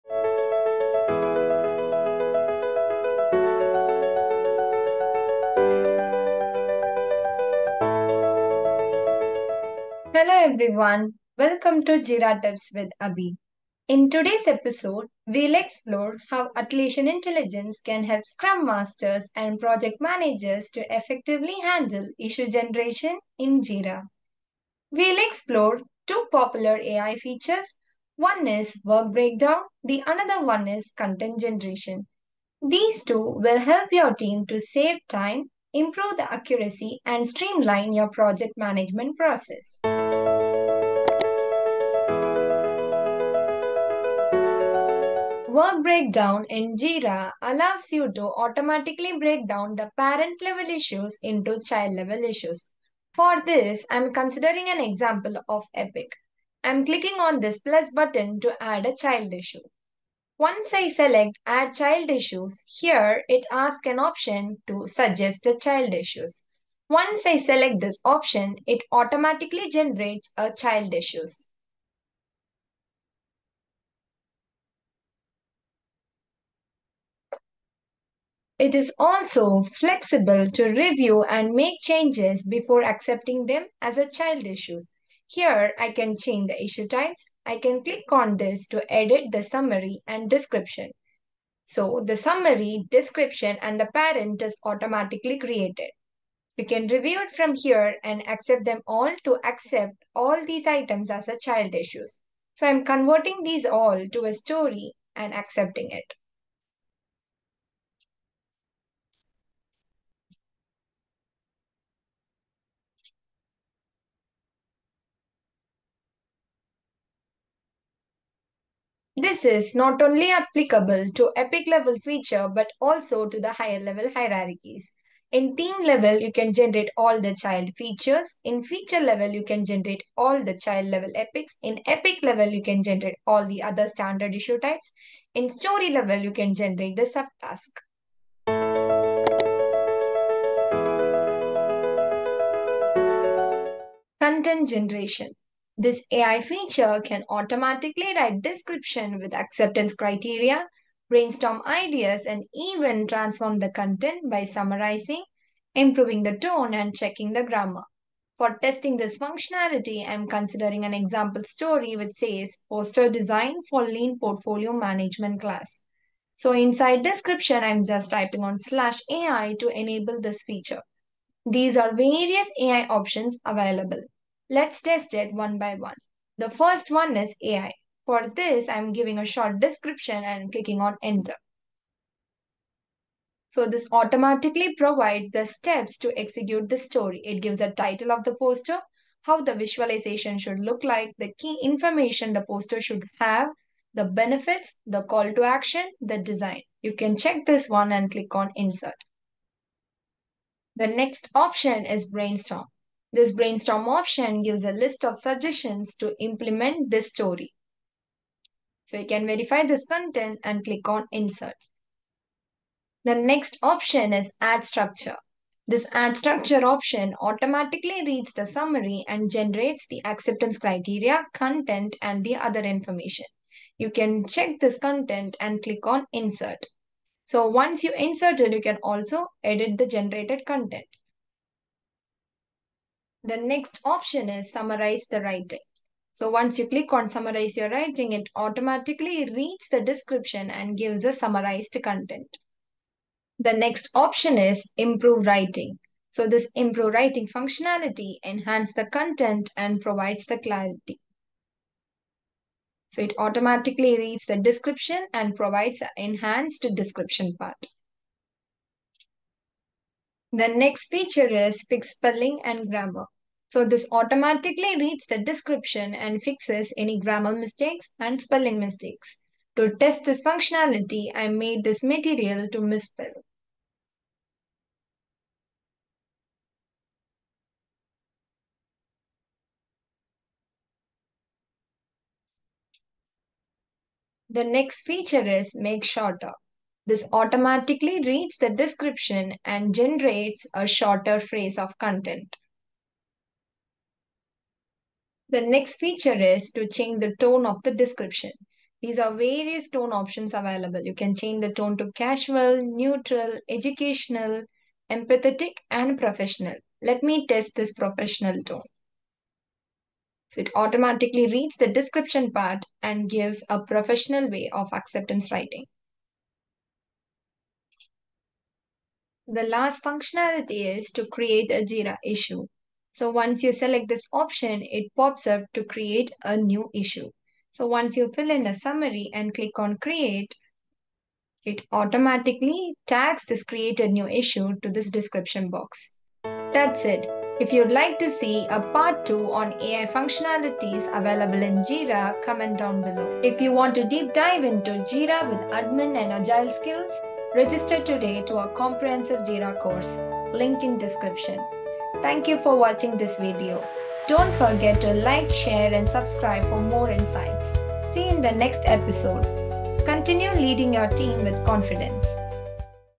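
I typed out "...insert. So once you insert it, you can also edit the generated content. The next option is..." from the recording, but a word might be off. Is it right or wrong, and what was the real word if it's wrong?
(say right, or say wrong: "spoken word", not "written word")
right.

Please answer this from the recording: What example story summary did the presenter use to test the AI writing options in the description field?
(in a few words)
Poster design for lean portfolio management class.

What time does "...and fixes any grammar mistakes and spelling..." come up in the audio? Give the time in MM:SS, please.
04:25.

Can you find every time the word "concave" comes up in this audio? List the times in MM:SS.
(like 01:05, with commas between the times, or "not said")
not said.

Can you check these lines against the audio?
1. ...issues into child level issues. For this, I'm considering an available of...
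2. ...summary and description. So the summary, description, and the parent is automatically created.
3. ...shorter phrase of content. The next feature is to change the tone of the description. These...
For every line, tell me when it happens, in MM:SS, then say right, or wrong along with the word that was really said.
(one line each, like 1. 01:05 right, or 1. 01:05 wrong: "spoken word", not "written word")
1. 00:50 wrong: "example", not "available"
2. 01:29 right
3. 04:50 right.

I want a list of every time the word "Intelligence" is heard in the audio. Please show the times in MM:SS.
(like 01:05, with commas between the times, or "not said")
00:17.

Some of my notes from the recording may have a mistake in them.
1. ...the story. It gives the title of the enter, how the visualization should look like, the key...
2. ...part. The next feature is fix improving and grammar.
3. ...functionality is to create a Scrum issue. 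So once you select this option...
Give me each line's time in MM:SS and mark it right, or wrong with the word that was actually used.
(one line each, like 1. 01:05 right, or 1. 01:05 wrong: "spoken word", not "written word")
1. 03:06 wrong: "poster", not "enter"
2. 04:17 wrong: "spelling", not "improving"
3. 05:19 wrong: "Jira", not "Scrum".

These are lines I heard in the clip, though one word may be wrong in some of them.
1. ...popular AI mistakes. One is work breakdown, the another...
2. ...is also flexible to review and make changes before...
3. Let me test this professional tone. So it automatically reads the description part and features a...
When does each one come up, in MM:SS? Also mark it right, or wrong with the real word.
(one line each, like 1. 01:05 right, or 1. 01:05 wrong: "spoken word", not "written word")
1. 00:26 wrong: "features", not "mistakes"
2. 01:18 right
3. 05:06 wrong: "gives", not "features".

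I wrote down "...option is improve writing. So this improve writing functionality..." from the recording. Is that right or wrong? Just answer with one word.
right.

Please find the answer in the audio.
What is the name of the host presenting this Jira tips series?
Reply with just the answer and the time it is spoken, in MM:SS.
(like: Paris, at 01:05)
Abi, at 00:13.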